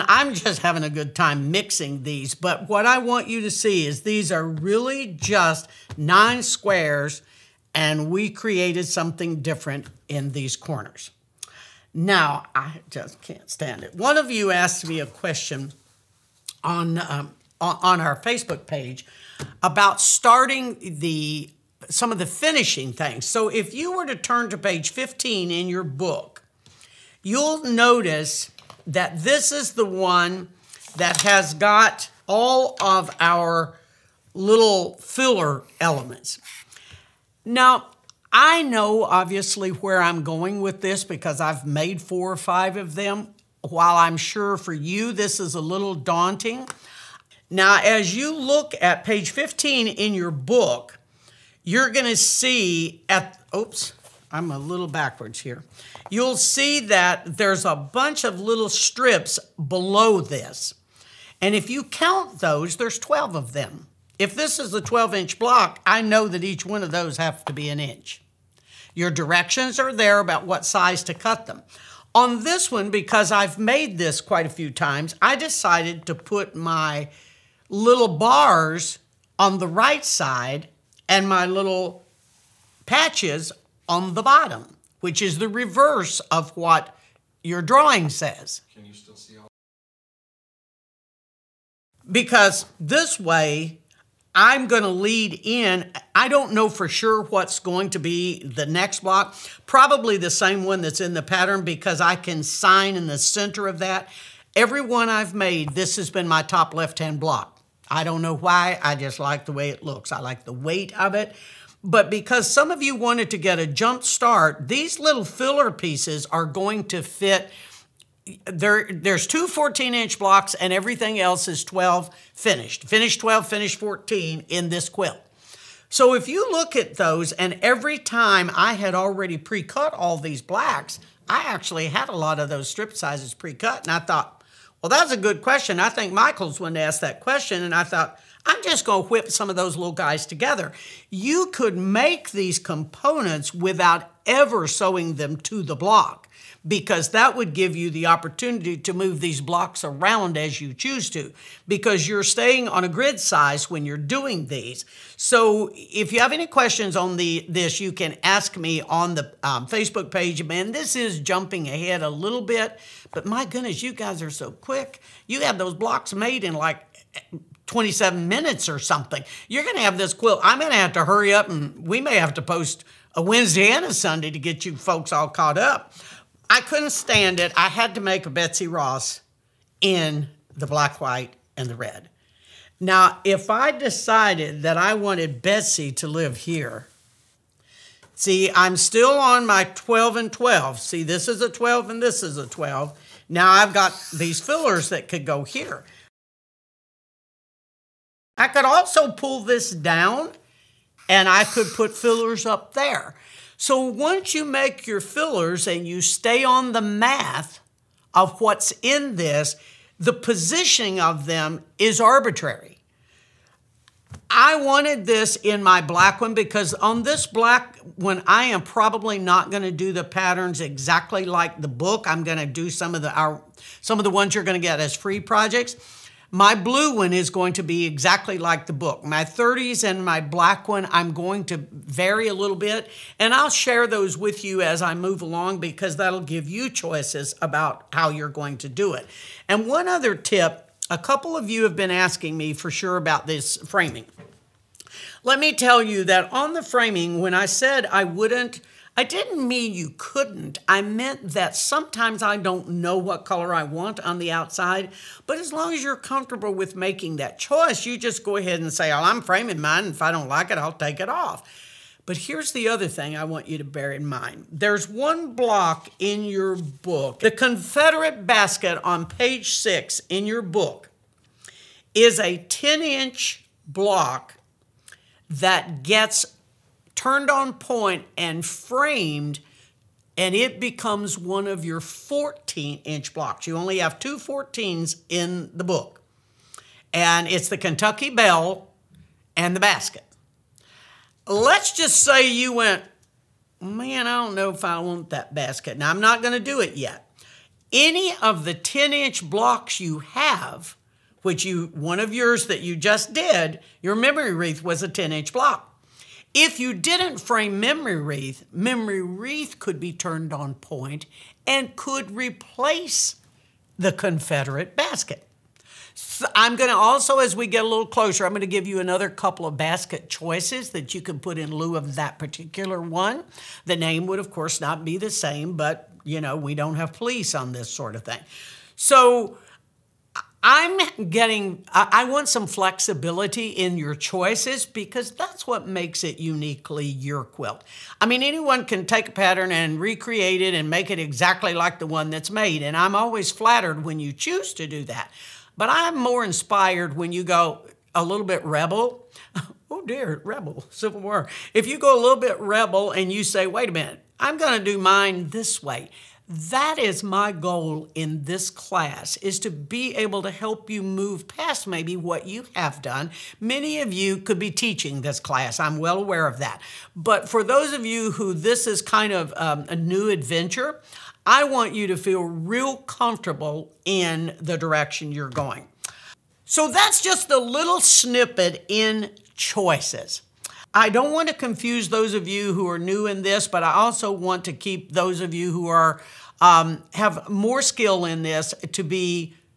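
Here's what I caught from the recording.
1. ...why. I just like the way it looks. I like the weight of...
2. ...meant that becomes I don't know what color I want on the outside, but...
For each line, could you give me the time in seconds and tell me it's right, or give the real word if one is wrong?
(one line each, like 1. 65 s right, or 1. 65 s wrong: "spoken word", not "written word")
1. 108 s right
2. 250 s wrong: "sometimes", not "becomes".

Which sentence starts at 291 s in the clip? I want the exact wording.
Let's just say you went, man, I don't know if I want that basket.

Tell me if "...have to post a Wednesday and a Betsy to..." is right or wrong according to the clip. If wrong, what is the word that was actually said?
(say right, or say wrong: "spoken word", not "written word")
wrong: "Sunday", not "Betsy".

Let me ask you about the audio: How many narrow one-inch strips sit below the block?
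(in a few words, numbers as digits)
12.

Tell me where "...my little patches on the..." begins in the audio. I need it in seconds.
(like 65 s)
81 s.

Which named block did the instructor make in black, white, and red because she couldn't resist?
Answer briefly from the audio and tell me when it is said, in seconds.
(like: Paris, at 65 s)
Betsy Ross, at 178 s.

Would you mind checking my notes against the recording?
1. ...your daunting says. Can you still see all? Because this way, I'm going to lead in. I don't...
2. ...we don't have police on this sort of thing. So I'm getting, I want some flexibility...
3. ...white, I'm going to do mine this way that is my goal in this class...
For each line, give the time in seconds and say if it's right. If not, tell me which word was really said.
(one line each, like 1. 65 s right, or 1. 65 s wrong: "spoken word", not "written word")
1. 87 s wrong: "drawing", not "daunting"
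2. 326 s right
3. 353 s wrong: "minute", not "white".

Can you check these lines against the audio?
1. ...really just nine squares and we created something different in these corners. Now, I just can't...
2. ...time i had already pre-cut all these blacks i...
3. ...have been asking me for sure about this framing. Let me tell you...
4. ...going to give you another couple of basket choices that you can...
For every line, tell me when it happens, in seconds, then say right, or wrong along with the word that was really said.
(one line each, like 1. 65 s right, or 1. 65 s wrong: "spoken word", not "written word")
1. 4 s right
2. 127 s right
3. 241 s right
4. 318 s right.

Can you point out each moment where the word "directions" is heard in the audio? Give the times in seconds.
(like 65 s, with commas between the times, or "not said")
69 s, 374 s.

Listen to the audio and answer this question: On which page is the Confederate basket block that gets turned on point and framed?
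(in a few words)
6.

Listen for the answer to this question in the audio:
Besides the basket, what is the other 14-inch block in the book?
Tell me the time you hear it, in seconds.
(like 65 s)
287 s.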